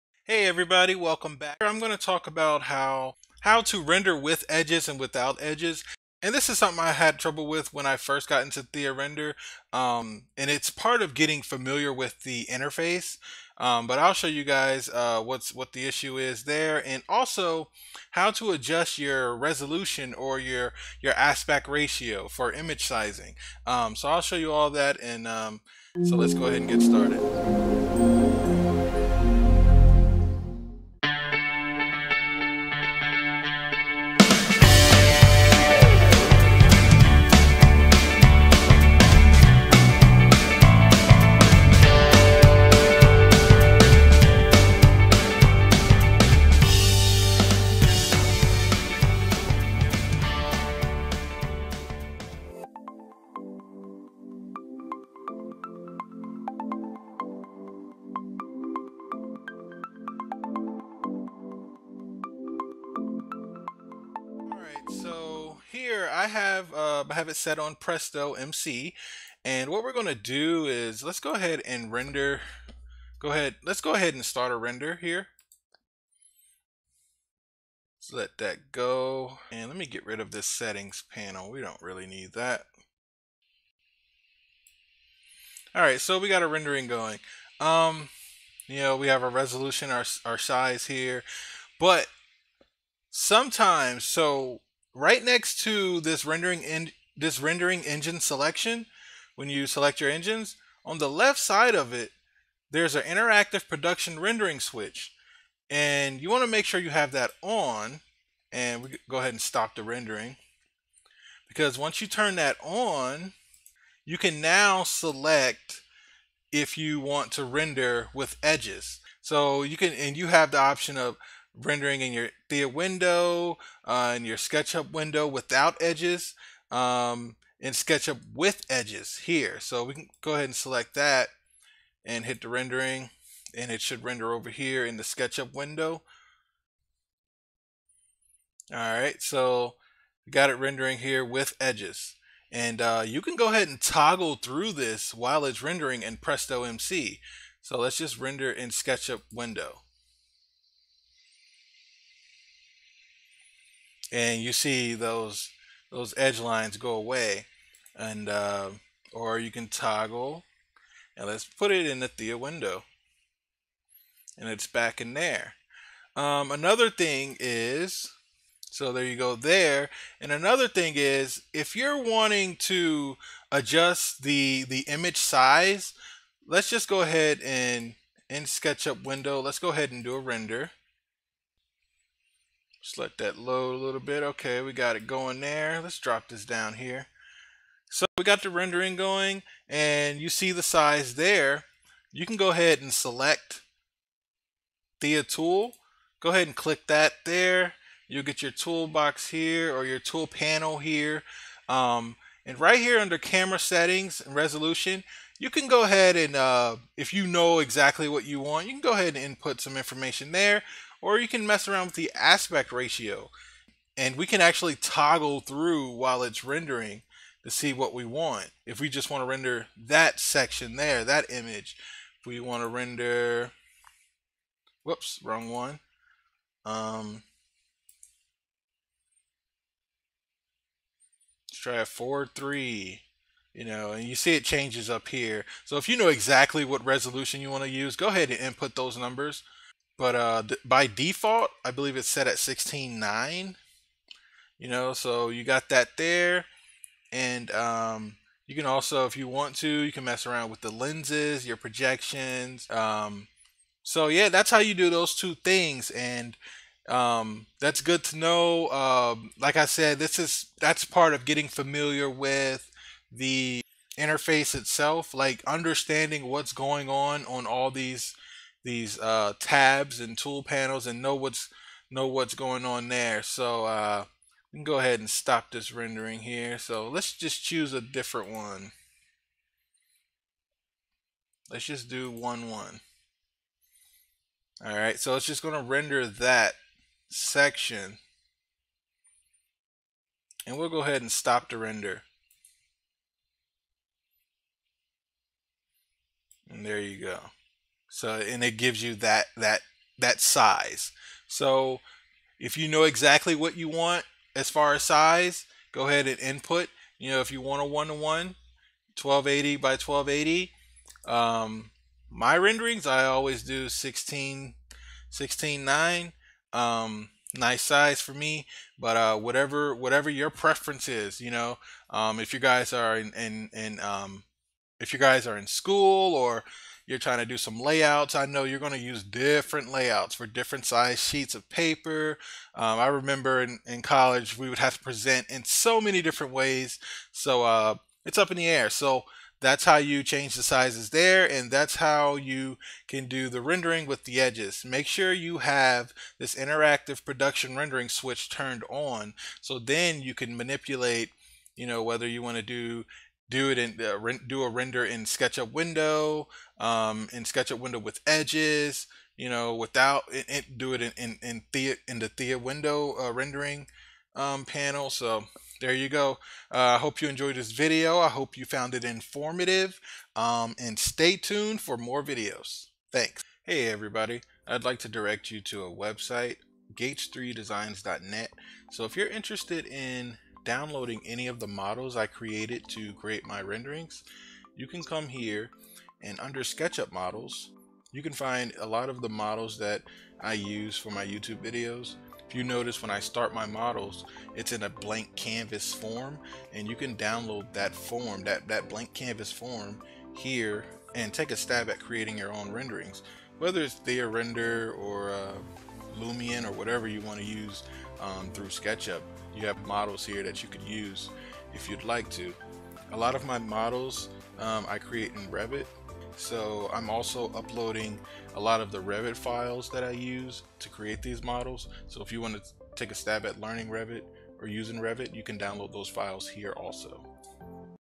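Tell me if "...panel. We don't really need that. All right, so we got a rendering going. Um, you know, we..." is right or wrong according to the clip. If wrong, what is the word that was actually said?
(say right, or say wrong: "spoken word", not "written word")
right.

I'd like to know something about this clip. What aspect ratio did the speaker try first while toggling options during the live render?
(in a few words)
4:3.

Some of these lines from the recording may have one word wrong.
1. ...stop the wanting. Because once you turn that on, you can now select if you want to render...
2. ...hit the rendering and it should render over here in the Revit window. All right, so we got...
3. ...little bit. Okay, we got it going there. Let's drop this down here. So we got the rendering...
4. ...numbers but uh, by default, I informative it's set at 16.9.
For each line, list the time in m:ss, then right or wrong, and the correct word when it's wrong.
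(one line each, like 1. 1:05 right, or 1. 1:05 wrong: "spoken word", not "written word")
1. 1:49 wrong: "rendering", not "wanting"
2. 2:12 wrong: "SketchUp", not "Revit"
3. 3:03 right
4. 3:58 wrong: "believe", not "informative".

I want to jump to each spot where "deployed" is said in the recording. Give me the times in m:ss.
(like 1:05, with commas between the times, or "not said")
not said.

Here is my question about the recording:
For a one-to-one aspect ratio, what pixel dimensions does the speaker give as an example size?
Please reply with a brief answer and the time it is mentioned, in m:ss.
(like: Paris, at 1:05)
1280 by 1280, at 5:08.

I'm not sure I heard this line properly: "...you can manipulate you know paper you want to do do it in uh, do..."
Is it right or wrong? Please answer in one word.
wrong.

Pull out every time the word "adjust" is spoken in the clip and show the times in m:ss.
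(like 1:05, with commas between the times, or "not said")
0:18, 2:53.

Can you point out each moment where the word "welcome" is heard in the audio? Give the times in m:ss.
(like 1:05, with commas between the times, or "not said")
0:00.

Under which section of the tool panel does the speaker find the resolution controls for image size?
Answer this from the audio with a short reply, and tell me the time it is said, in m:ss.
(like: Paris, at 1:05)
camera settings, at 3:23.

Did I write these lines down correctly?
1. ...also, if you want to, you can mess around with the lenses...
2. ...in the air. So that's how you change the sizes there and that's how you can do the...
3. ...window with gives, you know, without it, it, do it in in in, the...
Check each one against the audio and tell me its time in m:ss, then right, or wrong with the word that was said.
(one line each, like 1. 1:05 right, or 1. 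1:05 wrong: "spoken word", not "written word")
1. 4:08 right
2. 5:38 right
3. 5:57 wrong: "edges", not "gives".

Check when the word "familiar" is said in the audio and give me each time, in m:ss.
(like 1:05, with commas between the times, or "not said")
0:11, 4:21.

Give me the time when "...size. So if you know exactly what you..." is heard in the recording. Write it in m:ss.
5:00.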